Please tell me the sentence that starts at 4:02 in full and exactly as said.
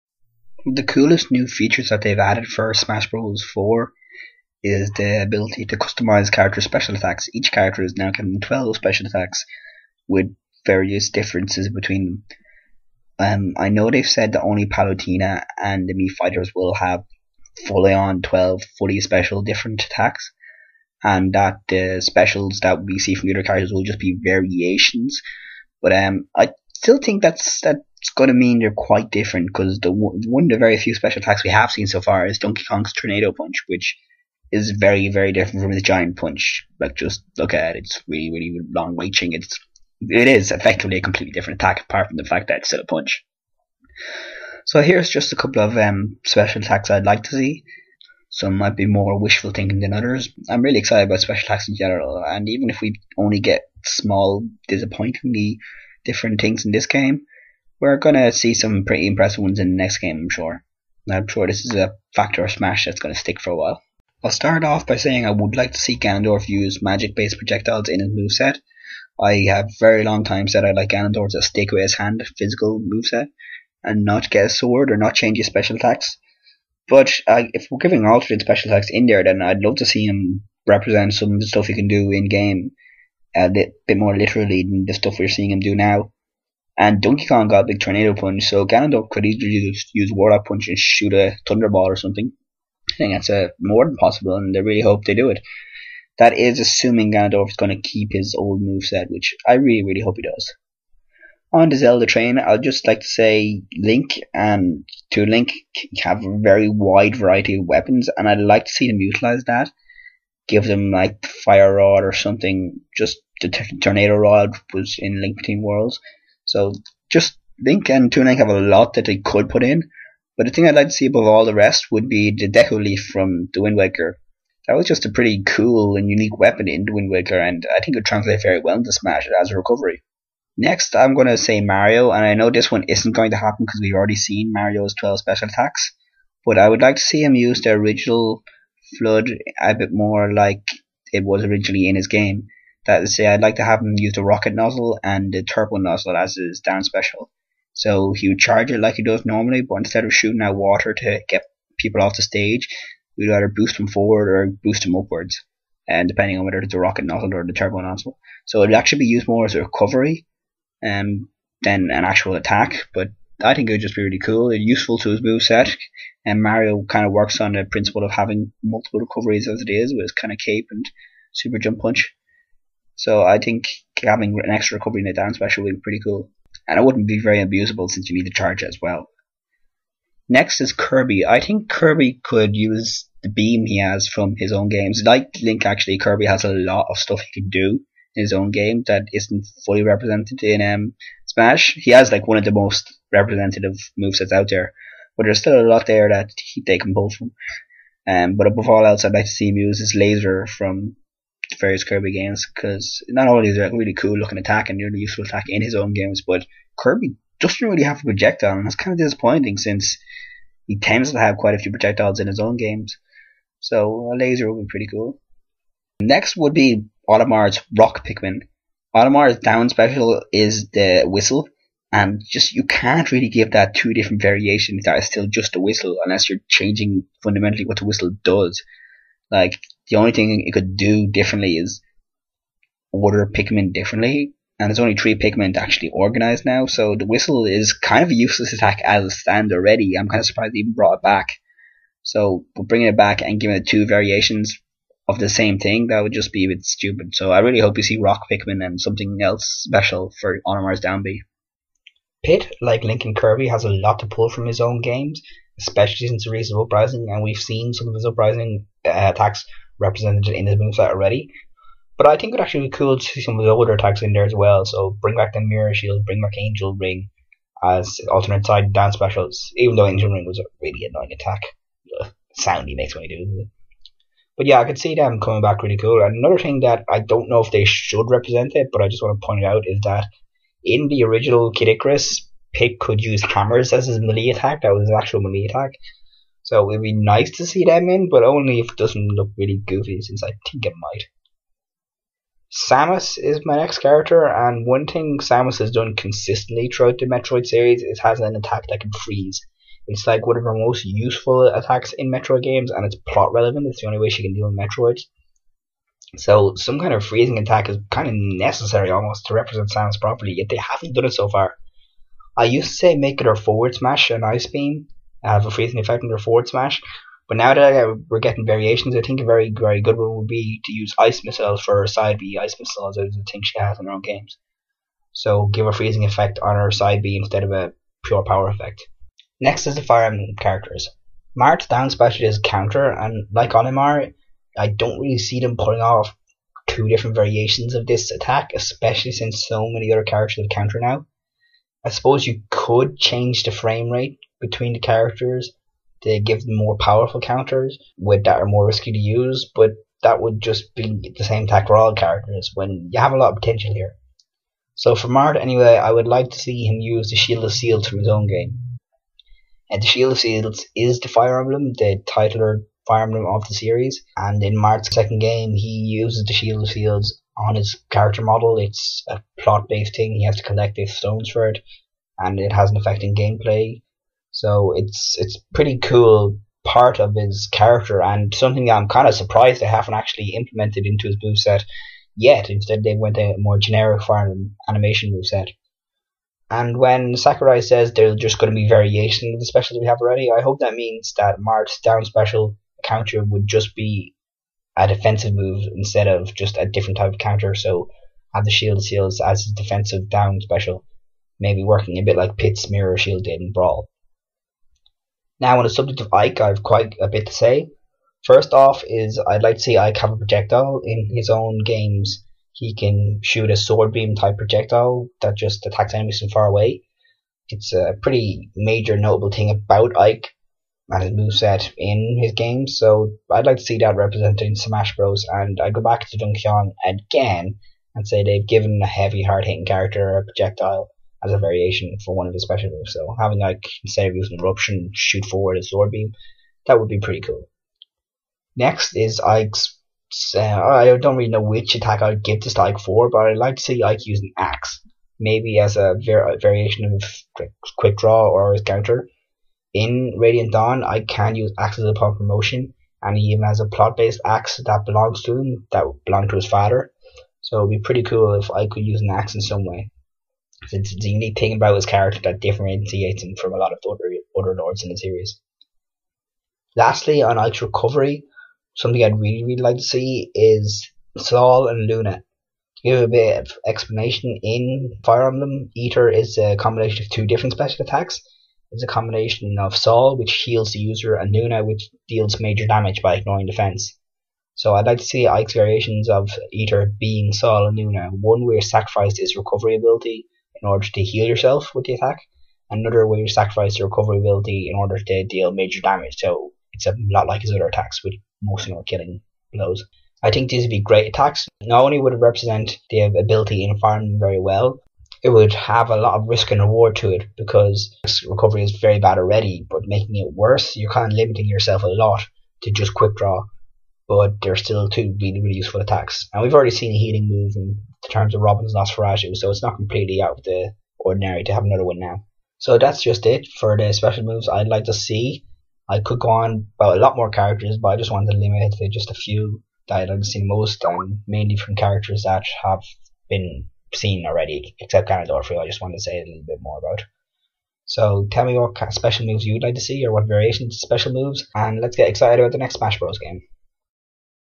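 So bringing it back and giving it two variations of the same thing, that would just be a bit stupid.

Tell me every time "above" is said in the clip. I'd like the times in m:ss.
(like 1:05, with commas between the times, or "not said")
2:01, 3:18.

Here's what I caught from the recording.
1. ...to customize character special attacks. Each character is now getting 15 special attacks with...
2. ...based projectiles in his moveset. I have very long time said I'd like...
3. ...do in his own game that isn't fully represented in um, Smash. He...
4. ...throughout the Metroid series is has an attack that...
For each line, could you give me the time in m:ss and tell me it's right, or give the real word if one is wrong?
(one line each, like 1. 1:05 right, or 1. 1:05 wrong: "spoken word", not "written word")
1. 0:05 wrong: "12", not "15"
2. 1:07 right
3. 3:07 right
4. 4:56 right.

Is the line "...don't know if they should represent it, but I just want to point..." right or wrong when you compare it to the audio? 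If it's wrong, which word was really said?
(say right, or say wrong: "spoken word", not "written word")
right.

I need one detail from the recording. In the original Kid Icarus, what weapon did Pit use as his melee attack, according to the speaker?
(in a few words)
hammers.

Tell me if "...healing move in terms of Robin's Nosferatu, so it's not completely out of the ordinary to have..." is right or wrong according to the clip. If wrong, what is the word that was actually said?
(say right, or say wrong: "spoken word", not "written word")
right.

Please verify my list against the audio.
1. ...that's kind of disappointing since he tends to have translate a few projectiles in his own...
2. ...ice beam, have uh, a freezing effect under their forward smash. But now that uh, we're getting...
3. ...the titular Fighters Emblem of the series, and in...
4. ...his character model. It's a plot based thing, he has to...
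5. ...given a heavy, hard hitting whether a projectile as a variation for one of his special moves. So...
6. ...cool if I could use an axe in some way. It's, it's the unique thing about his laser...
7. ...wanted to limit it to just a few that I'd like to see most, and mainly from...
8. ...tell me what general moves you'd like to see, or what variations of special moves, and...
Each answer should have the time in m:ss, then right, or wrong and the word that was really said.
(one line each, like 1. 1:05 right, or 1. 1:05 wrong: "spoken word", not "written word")
1. 3:28 wrong: "quite", not "translate"
2. 5:14 right
3. 6:01 wrong: "Fire", not "Fighters"
4. 6:07 right
5. 7:08 wrong: "character", not "whether"
6. 7:38 wrong: "character", not "laser"
7. 8:48 right
8. 8:58 wrong: "special", not "general".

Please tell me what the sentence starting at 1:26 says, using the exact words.
And Donkey Kong got a big tornado punch, so Ganondorf could easily just use Warlock Punch and shoot a Thunderball or something.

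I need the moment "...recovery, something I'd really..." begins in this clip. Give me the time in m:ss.
7:47.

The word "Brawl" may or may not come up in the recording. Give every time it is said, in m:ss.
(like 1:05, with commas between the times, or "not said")
6:43.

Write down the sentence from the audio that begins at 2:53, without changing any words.
So I think having an extra recovery in a down special would be pretty cool.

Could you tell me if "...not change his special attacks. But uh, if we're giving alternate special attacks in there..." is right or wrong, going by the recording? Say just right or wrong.
right.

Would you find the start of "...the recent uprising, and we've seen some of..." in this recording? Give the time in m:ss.
4:16.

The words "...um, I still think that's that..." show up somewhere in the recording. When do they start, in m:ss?
0:25.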